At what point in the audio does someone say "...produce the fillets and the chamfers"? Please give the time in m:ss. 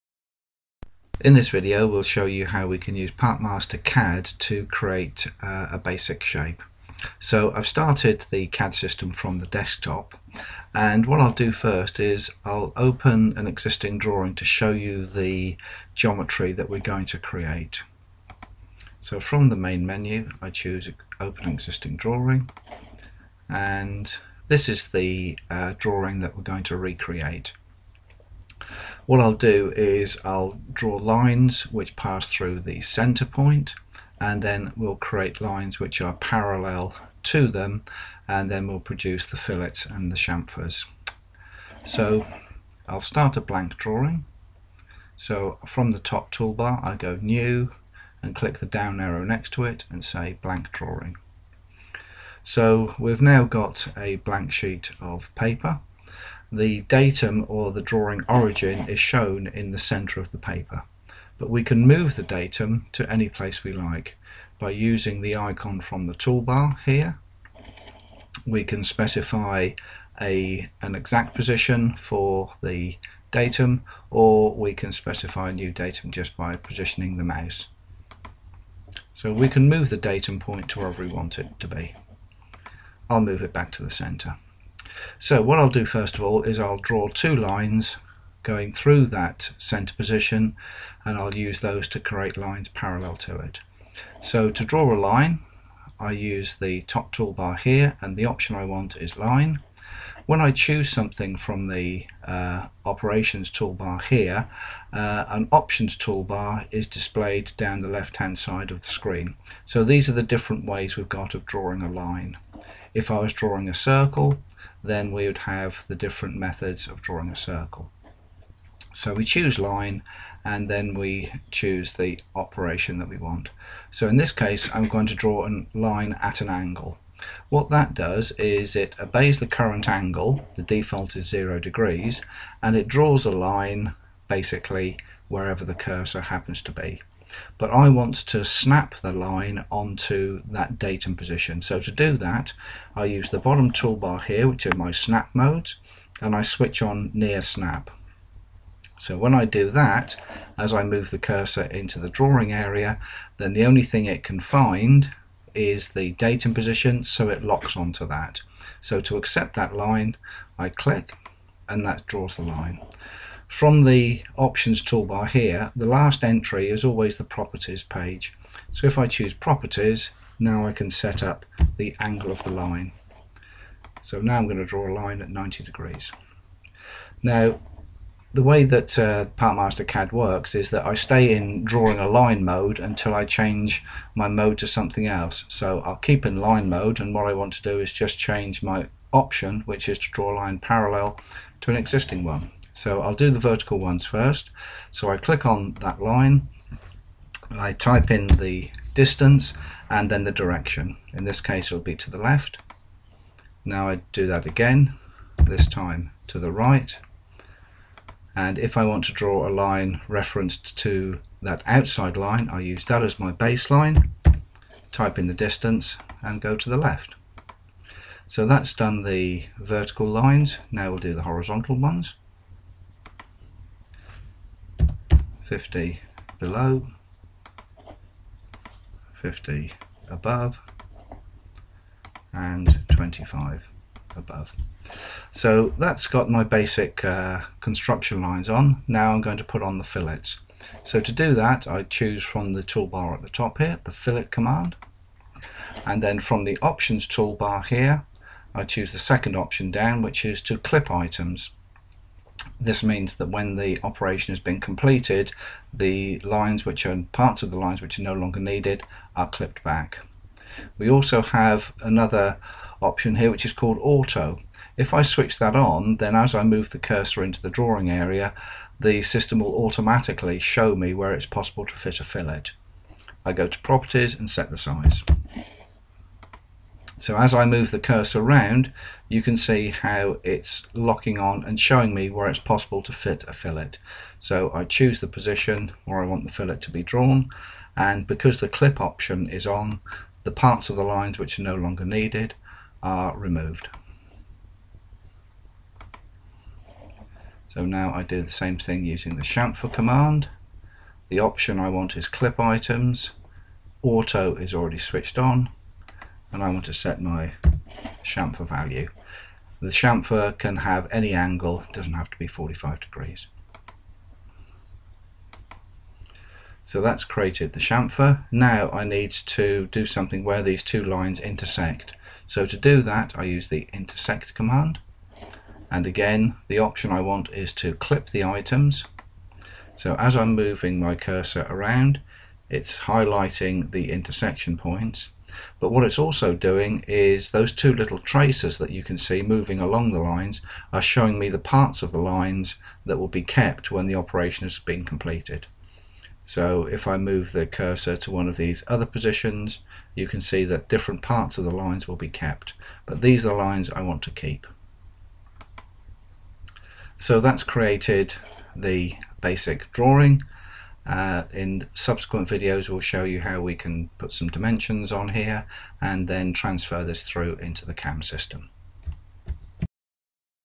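0:38.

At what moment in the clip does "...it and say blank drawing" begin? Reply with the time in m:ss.
0:49.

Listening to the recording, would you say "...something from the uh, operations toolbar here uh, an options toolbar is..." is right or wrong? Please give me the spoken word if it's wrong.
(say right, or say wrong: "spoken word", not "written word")
right.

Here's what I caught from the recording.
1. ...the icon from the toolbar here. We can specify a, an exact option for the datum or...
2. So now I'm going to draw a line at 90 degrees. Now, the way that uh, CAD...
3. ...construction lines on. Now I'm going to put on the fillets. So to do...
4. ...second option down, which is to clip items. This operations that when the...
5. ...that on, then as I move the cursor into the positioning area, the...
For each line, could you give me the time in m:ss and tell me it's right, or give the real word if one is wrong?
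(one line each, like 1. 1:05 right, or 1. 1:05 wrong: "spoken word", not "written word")
1. 1:05 wrong: "position", not "option"
2. 2:54 wrong: "PartMaster", not "CAD"
3. 3:57 right
4. 4:08 wrong: "means", not "operations"
5. 4:25 wrong: "drawing", not "positioning".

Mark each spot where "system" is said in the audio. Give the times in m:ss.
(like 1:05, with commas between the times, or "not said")
0:08, 4:29, 6:08.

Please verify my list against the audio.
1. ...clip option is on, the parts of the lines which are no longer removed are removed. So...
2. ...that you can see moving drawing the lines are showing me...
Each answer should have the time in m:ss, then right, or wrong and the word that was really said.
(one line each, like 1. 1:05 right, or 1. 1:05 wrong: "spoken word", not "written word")
1. 4:48 wrong: "needed", not "removed"
2. 5:38 wrong: "along", not "drawing".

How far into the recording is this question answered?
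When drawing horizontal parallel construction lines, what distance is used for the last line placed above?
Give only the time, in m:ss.
3:52.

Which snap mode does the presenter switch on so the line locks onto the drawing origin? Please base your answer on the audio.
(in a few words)
near snap.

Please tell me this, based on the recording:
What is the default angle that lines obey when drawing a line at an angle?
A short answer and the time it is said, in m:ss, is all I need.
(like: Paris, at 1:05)
0 degrees, at 2:11.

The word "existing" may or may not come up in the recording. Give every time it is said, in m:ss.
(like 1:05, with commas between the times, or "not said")
0:13, 0:21, 3:11.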